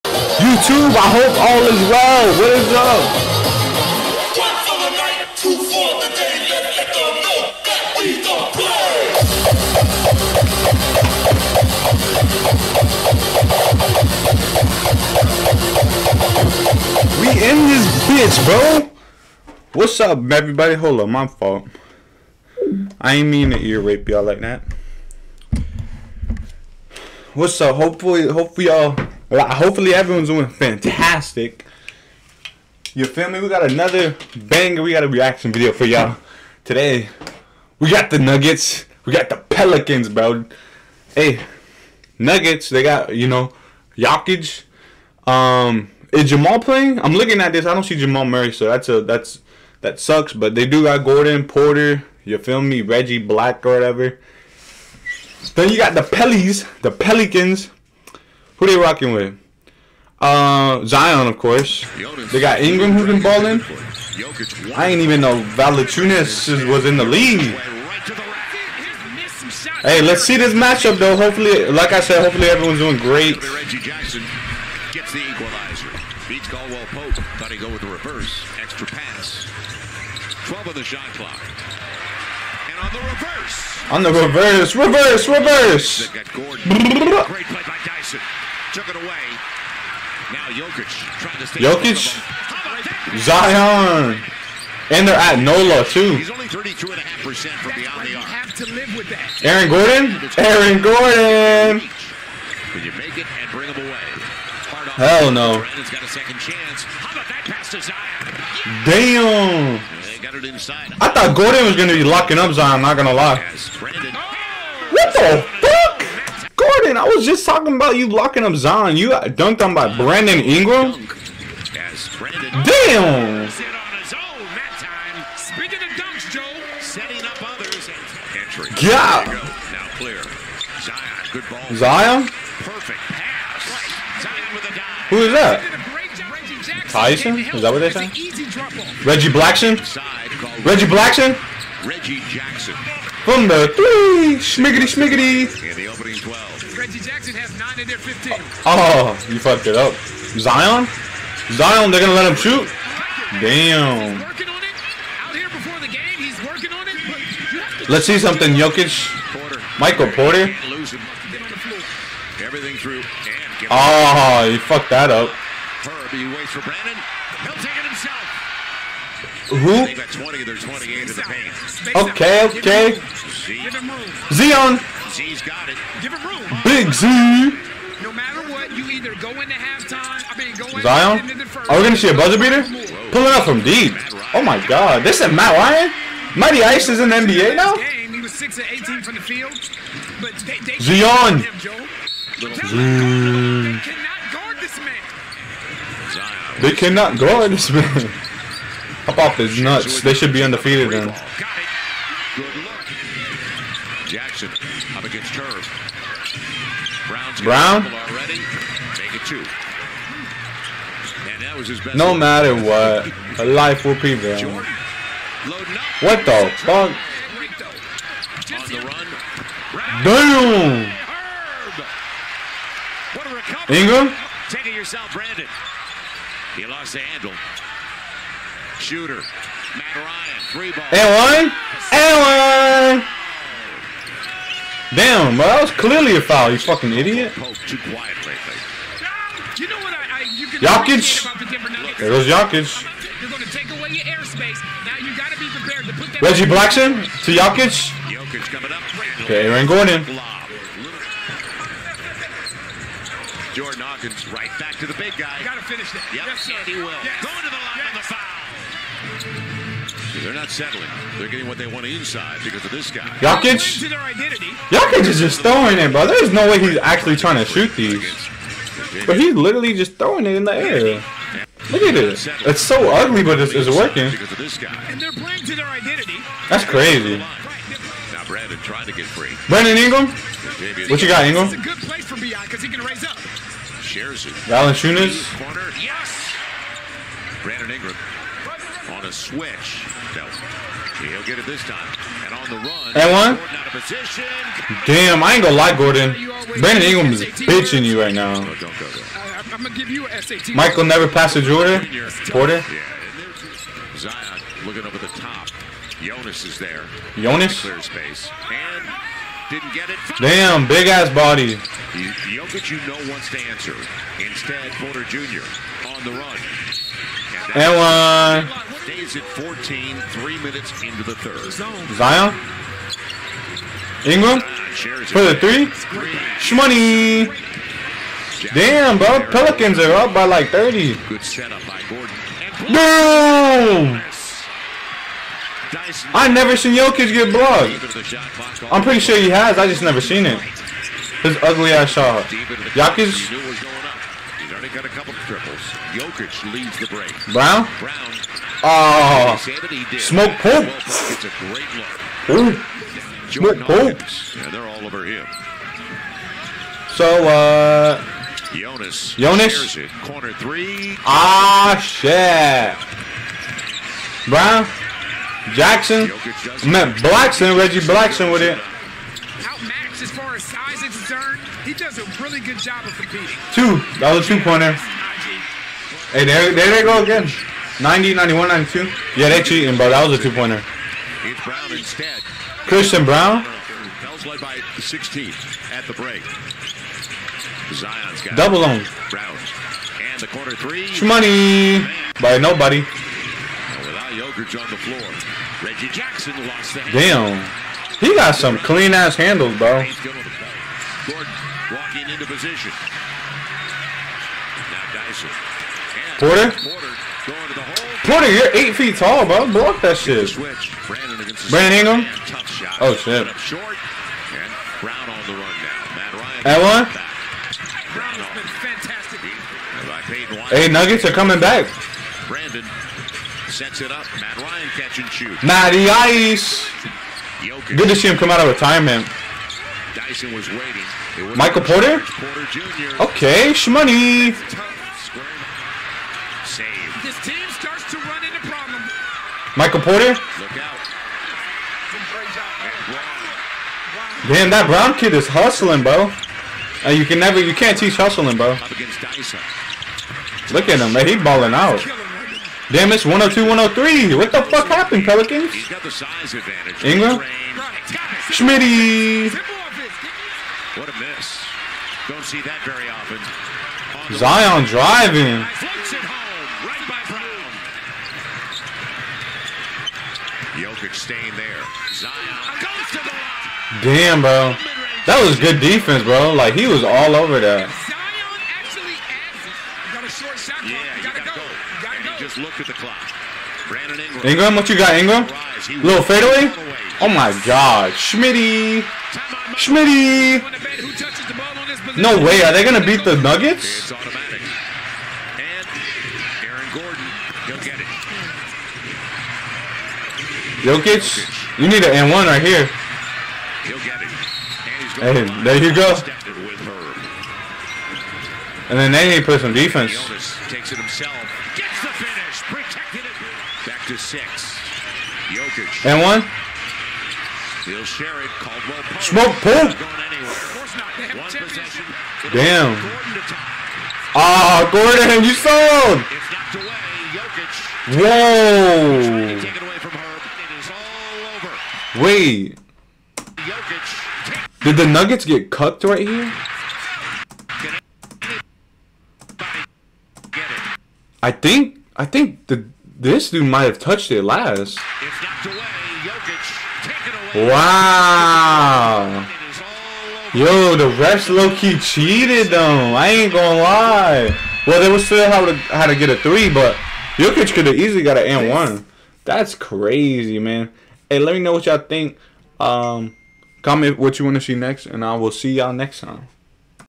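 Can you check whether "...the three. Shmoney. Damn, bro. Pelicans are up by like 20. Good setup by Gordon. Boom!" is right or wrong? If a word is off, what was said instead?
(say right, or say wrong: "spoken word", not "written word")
wrong: "30", not "20".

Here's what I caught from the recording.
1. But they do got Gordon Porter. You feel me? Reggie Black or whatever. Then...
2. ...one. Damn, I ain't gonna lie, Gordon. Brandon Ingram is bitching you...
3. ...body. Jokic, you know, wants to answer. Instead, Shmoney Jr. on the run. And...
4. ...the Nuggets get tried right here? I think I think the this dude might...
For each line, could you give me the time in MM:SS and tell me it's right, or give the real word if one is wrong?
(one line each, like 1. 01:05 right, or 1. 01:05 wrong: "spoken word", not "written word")
1. 00:50 right
2. 04:53 right
3. 05:11 wrong: "Porter", not "Shmoney"
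4. 08:54 wrong: "cucked", not "tried".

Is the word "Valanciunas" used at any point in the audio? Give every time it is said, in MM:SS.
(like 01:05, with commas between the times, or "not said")
01:05, 04:43.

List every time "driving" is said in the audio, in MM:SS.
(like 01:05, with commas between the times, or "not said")
07:44.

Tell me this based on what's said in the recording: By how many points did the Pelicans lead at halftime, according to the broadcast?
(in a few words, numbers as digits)
16.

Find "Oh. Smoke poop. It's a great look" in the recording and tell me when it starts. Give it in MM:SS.
05:48.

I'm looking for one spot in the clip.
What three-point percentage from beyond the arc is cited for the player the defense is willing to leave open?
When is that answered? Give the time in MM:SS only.
01:36.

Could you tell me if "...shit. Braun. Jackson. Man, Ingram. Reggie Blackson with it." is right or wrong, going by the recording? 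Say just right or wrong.
wrong.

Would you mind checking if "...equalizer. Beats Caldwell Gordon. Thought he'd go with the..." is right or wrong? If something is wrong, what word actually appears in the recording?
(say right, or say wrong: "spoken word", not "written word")
wrong: "Pope", not "Gordon".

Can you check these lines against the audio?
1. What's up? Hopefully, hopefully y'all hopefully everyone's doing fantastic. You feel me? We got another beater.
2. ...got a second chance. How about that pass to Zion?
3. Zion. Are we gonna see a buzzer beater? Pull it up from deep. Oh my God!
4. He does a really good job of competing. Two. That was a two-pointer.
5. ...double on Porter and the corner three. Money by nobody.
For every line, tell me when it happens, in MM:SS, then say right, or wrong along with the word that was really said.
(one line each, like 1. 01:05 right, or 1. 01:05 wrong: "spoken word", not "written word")
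1. 00:27 wrong: "banger", not "beater"
2. 01:45 right
3. 03:00 right
4. 06:11 right
5. 06:28 wrong: "Braun", not "Porter".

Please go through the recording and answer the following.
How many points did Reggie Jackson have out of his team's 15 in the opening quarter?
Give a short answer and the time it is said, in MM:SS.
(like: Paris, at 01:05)
9, at 02:27.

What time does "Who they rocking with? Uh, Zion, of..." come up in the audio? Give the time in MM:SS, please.
00:58.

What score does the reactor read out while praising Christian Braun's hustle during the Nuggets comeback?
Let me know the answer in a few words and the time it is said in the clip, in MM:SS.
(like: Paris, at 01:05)
102-103, at 07:33.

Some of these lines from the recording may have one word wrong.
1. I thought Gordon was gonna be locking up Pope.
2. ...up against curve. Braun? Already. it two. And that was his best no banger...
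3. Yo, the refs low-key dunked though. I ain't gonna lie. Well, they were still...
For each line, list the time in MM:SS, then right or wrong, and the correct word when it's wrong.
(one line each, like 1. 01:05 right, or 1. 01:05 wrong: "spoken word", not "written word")
1. 01:51 wrong: "Zion", not "Pope"
2. 03:24 wrong: "matter", not "banger"
3. 09:10 wrong: "cheated", not "dunked".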